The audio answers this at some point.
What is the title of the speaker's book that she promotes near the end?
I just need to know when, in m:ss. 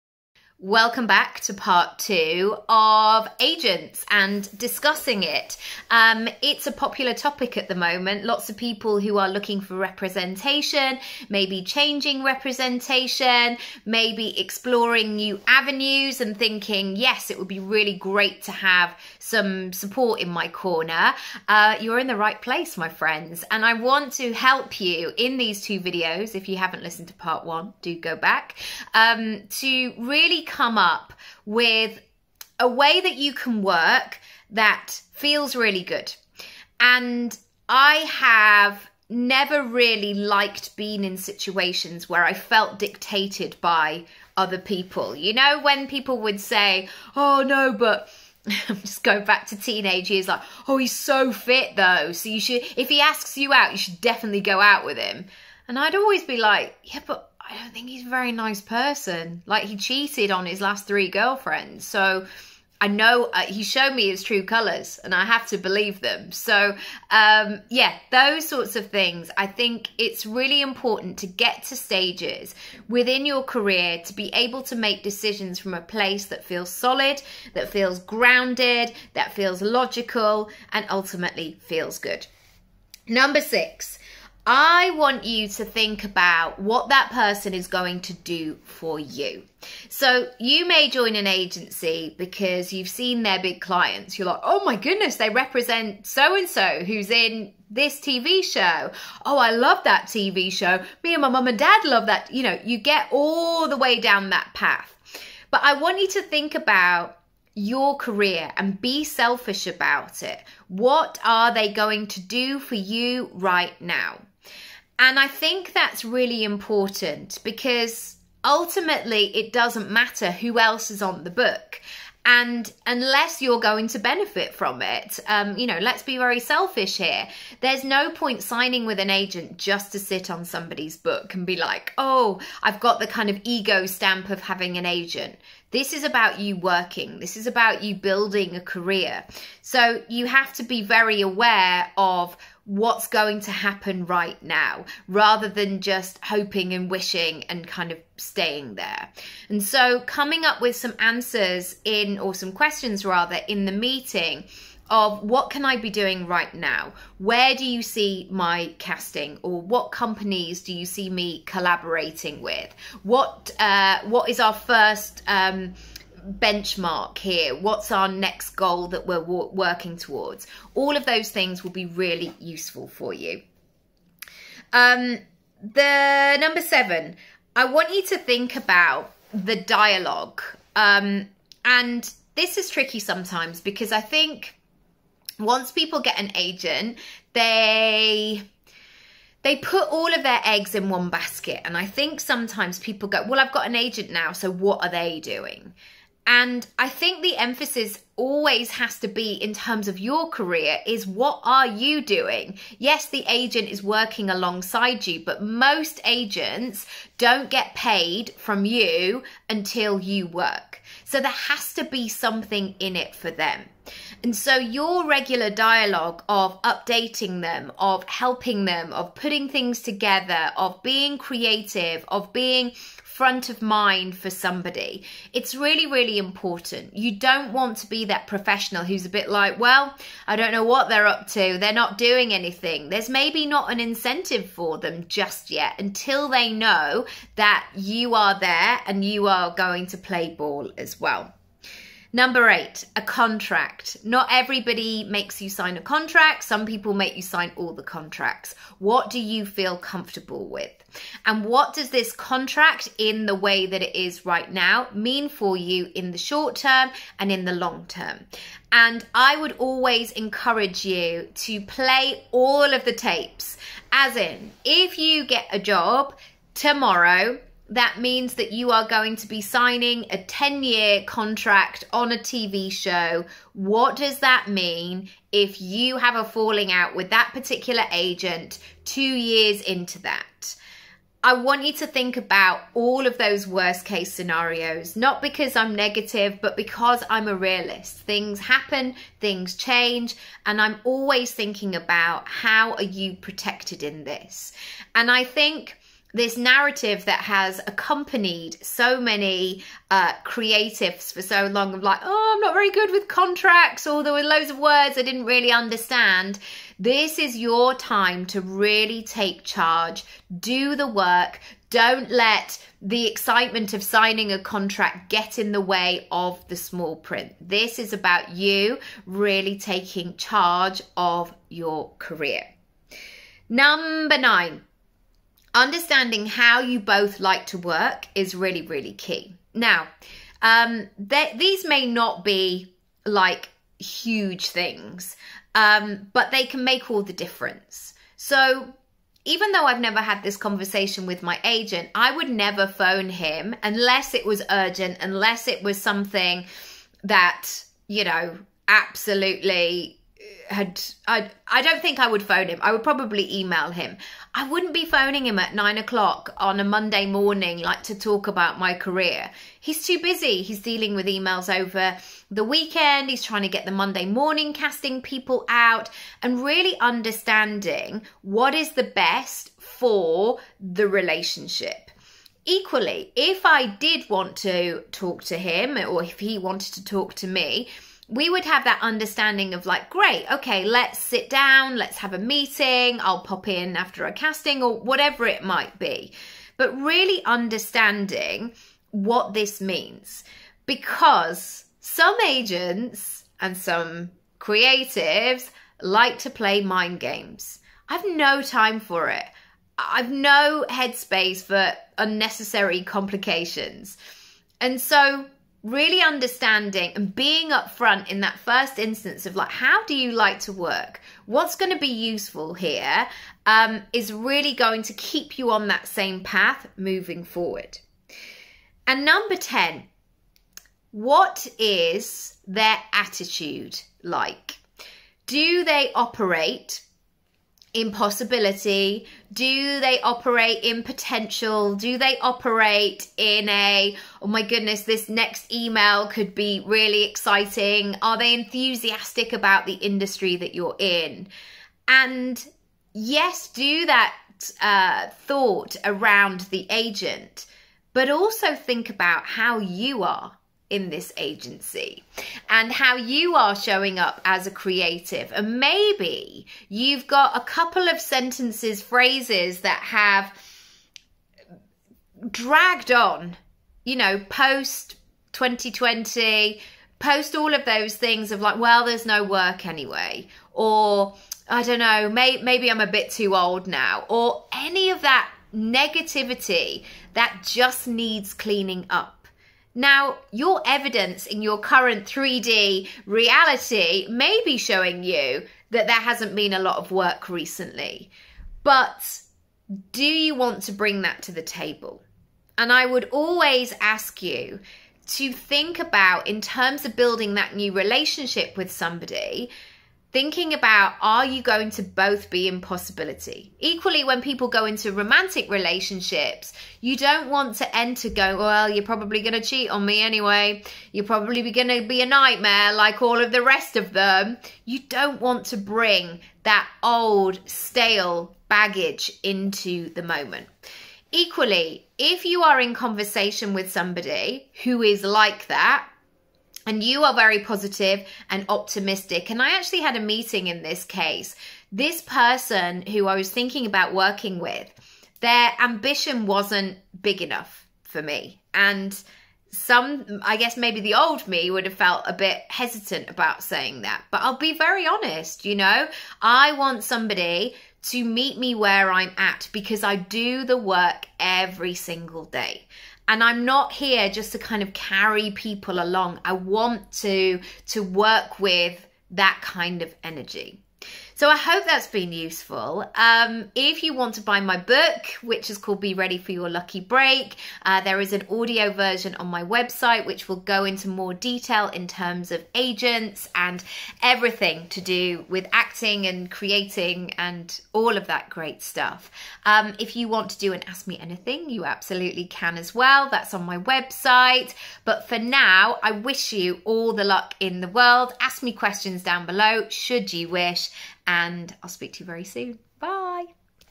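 9:25.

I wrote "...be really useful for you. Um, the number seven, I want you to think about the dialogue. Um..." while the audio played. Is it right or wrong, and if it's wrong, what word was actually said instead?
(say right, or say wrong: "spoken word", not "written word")
right.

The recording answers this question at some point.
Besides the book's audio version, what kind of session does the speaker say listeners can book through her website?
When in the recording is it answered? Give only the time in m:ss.
9:40.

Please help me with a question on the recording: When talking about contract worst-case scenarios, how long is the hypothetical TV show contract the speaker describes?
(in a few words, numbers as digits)
10 year.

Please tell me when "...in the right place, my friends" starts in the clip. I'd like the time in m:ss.
0:21.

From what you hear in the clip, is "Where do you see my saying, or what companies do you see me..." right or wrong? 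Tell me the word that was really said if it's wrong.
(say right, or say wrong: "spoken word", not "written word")
wrong: "casting", not "saying".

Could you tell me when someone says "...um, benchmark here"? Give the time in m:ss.
2:45.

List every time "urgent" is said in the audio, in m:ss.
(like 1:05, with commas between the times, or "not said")
5:44.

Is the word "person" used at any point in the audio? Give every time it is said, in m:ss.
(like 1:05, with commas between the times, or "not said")
0:58, 1:27, 8:52.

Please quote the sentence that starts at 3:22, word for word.
Yes, the agent is working alongside you, but most agents don't get paid from you until you work.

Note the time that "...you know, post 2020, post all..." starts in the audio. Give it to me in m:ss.
7:43.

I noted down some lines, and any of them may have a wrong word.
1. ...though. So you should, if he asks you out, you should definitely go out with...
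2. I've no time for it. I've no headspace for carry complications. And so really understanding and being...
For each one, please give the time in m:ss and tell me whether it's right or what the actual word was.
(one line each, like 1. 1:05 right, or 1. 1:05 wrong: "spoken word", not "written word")
1. 0:51 right
2. 6:37 wrong: "unnecessary", not "carry".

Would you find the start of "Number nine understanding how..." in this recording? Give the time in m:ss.
5:23.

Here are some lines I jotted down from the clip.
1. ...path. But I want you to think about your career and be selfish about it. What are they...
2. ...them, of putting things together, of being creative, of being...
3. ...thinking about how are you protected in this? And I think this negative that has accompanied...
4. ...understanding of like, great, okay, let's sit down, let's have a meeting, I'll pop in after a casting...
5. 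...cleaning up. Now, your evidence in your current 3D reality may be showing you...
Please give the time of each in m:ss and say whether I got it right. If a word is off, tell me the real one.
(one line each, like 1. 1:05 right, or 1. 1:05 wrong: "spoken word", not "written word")
1. 1:44 right
2. 3:38 right
3. 4:51 wrong: "narrative", not "negative"
4. 6:18 right
5. 7:58 right.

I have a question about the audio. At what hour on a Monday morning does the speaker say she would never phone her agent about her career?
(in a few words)
9 o'clock.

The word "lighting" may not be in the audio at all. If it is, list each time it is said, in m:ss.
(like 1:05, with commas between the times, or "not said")
not said.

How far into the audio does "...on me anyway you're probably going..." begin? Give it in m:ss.
8:29.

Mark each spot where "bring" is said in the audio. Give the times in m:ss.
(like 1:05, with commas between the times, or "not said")
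8:10, 8:35.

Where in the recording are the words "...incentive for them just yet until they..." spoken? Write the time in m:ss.
3:53.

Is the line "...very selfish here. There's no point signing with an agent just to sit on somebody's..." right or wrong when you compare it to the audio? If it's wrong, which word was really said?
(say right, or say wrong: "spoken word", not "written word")
right.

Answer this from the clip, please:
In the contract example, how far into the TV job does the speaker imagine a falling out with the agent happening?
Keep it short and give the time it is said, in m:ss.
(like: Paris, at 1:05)
2 years, at 4:38.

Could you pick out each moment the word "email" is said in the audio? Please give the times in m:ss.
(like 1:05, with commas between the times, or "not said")
5:53, 6:01, 7:15.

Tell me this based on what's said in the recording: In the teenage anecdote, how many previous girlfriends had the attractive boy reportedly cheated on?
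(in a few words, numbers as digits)
3.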